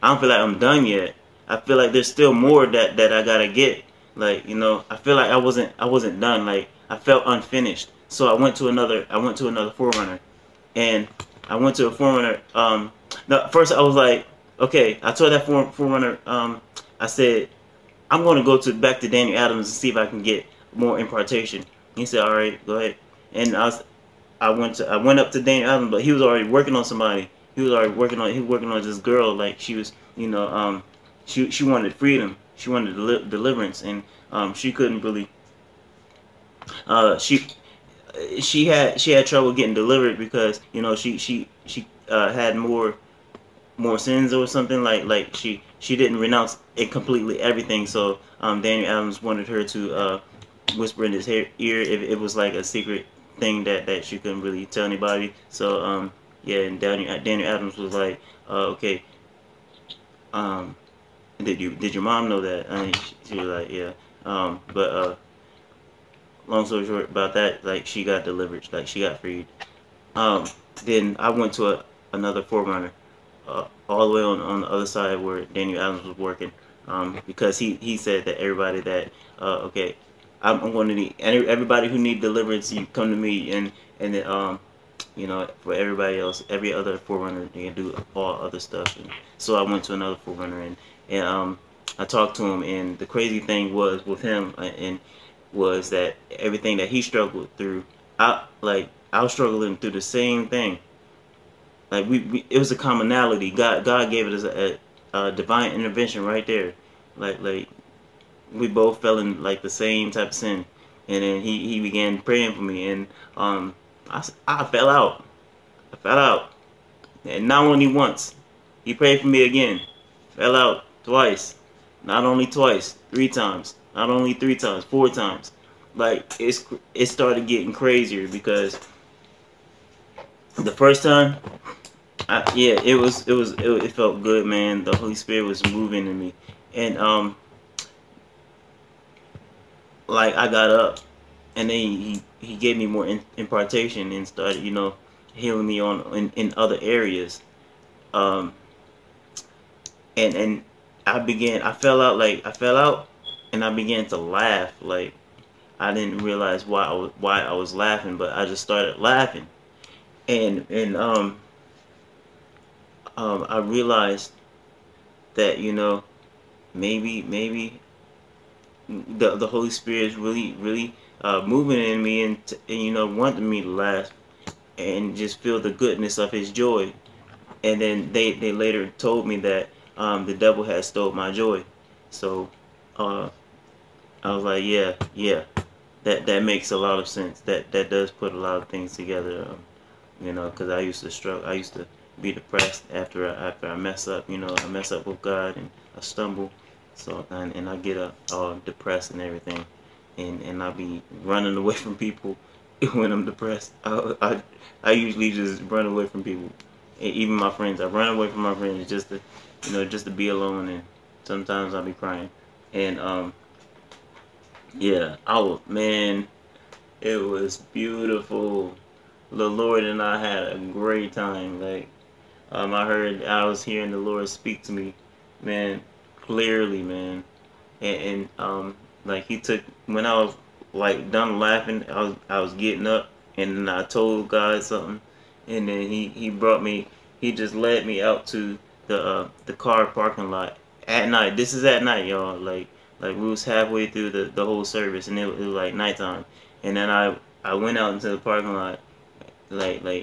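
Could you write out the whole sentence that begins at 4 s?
Like you know, I feel like I wasn't I wasn't done.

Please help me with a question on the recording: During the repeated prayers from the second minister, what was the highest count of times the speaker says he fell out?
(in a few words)
4 times.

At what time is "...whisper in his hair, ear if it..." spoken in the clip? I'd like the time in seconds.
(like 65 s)
50 s.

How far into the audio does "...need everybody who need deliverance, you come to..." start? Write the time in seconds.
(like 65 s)
80 s.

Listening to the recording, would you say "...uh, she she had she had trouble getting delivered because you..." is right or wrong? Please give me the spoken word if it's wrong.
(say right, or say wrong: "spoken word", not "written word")
right.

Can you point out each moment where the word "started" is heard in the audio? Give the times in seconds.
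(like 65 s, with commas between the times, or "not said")
127 s, 144 s, 158 s.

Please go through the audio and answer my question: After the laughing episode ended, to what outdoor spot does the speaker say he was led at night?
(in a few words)
The car parking lot.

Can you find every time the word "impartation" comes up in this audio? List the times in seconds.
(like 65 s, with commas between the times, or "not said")
20 s, 143 s.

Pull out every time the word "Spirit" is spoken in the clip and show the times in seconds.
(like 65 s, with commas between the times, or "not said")
135 s, 169 s.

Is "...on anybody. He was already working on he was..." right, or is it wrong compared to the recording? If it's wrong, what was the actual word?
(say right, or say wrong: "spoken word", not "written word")
wrong: "somebody", not "anybody".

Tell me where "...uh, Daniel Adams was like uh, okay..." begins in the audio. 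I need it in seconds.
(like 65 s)
57 s.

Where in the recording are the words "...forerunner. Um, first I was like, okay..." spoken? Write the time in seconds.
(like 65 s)
11 s.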